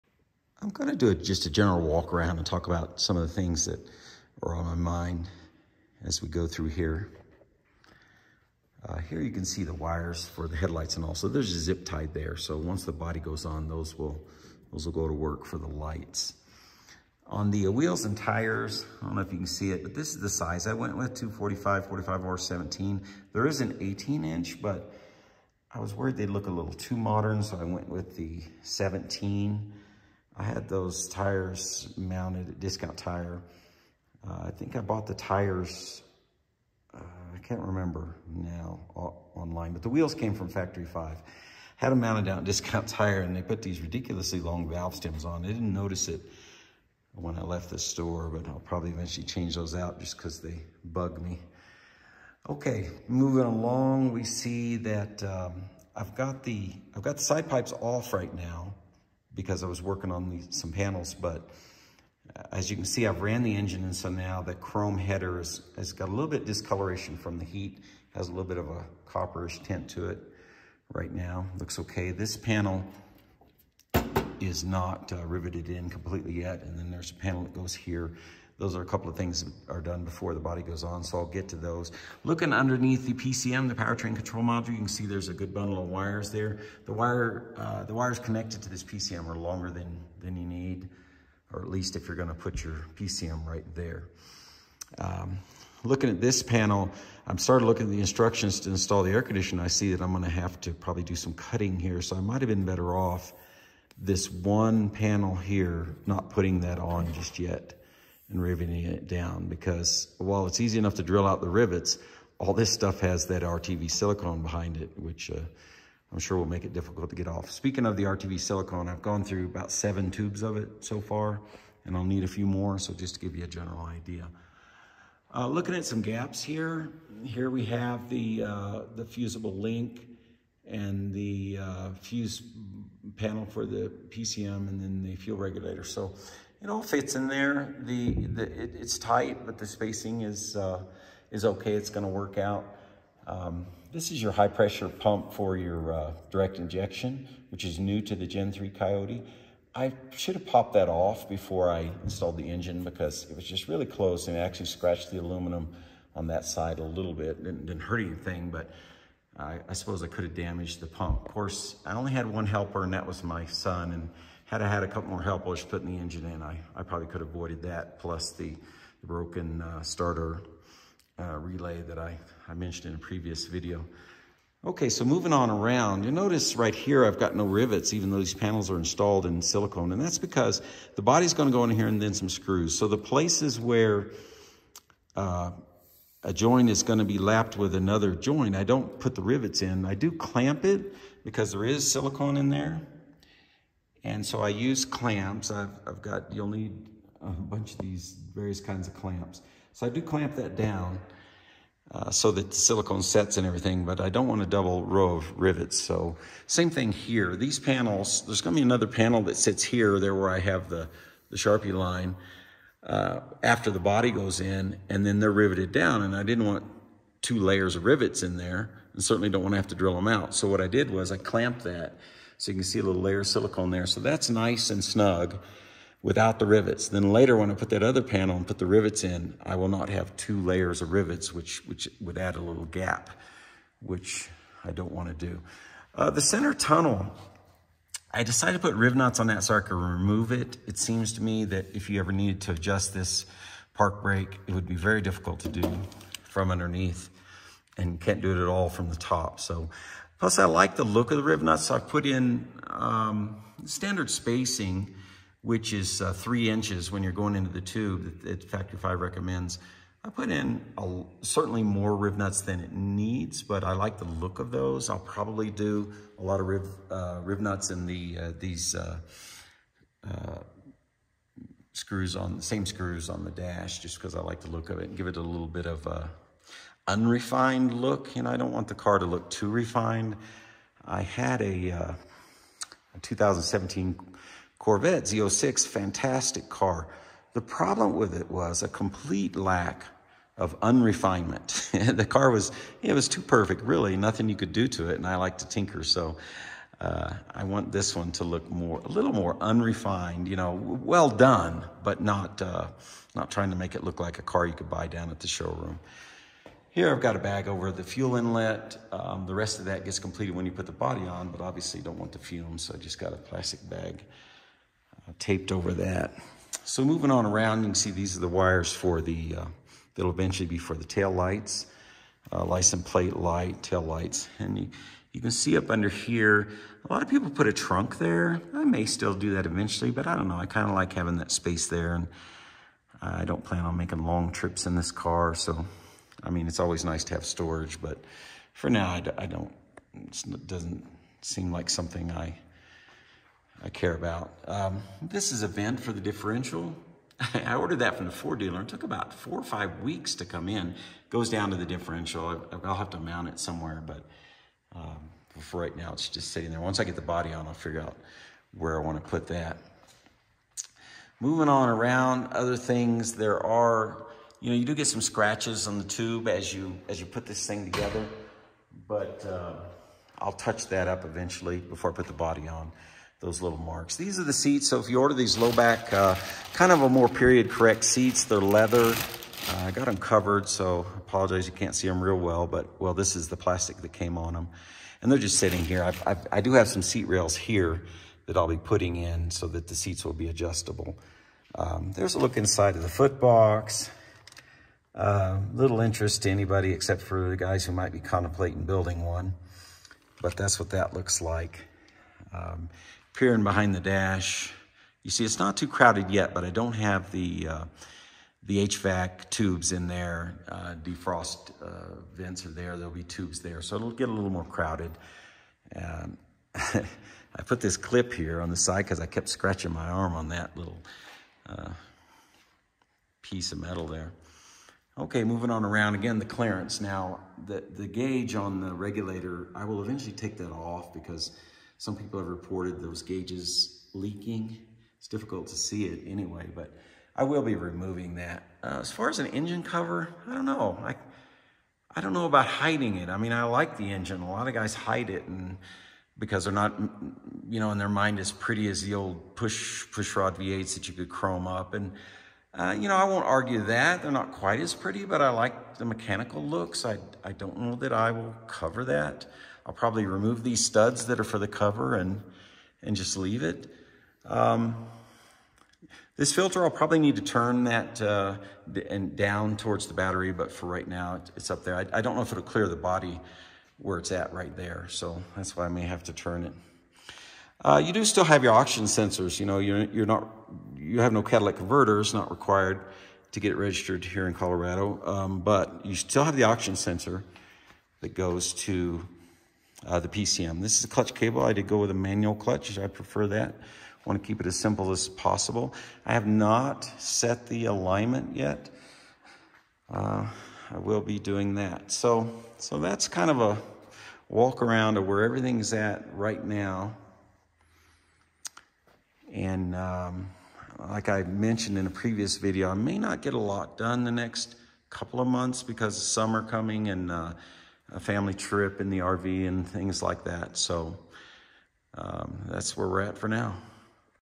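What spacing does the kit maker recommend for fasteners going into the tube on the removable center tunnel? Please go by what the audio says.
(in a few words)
3 inches.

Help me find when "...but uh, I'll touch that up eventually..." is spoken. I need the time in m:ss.
6:08.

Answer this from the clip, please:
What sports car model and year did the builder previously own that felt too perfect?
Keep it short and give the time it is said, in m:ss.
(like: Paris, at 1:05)
2017 Corvette Z06, at 4:43.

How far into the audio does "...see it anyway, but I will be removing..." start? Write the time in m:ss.
7:15.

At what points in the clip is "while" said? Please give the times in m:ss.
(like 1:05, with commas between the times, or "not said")
1:50.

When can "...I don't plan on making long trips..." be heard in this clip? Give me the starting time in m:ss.
5:33.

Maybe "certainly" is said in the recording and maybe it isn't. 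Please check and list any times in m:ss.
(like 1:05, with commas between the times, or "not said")
3:39, 4:21.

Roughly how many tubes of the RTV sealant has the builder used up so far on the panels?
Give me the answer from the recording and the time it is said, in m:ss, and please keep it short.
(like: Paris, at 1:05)
7, at 1:59.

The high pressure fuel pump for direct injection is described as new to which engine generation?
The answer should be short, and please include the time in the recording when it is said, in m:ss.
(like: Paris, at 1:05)
Gen 3 Coyote, at 2:28.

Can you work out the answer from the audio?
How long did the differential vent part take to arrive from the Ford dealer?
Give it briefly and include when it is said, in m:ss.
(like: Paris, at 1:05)
4 or 5 weeks, at 5:49.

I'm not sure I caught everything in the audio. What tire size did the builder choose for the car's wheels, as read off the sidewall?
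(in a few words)
245/45/17.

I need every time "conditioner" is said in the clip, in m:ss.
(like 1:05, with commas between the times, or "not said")
1:39.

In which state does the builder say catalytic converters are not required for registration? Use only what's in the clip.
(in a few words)
Colorado.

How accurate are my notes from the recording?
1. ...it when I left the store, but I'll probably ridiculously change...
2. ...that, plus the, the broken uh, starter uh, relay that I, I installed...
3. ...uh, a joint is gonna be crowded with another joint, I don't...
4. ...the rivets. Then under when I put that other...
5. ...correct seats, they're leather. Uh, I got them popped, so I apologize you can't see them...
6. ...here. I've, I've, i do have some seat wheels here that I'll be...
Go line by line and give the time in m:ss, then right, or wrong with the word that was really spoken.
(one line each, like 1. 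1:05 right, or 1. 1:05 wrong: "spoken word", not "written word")
1. 0:46 wrong: "eventually", not "ridiculously"
2. 2:47 wrong: "mentioned", not "installed"
3. 3:05 wrong: "lapped", not "crowded"
4. 3:46 wrong: "later", not "under"
5. 6:17 wrong: "covered", not "popped"
6. 6:25 wrong: "rails", not "wheels".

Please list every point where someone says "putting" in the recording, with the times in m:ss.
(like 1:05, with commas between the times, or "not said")
1:46, 2:45, 6:28.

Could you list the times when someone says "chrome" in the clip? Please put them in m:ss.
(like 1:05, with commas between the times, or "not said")
1:04, 7:31.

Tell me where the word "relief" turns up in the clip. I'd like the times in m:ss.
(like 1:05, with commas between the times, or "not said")
not said.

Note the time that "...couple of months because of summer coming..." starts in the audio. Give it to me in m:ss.
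8:34.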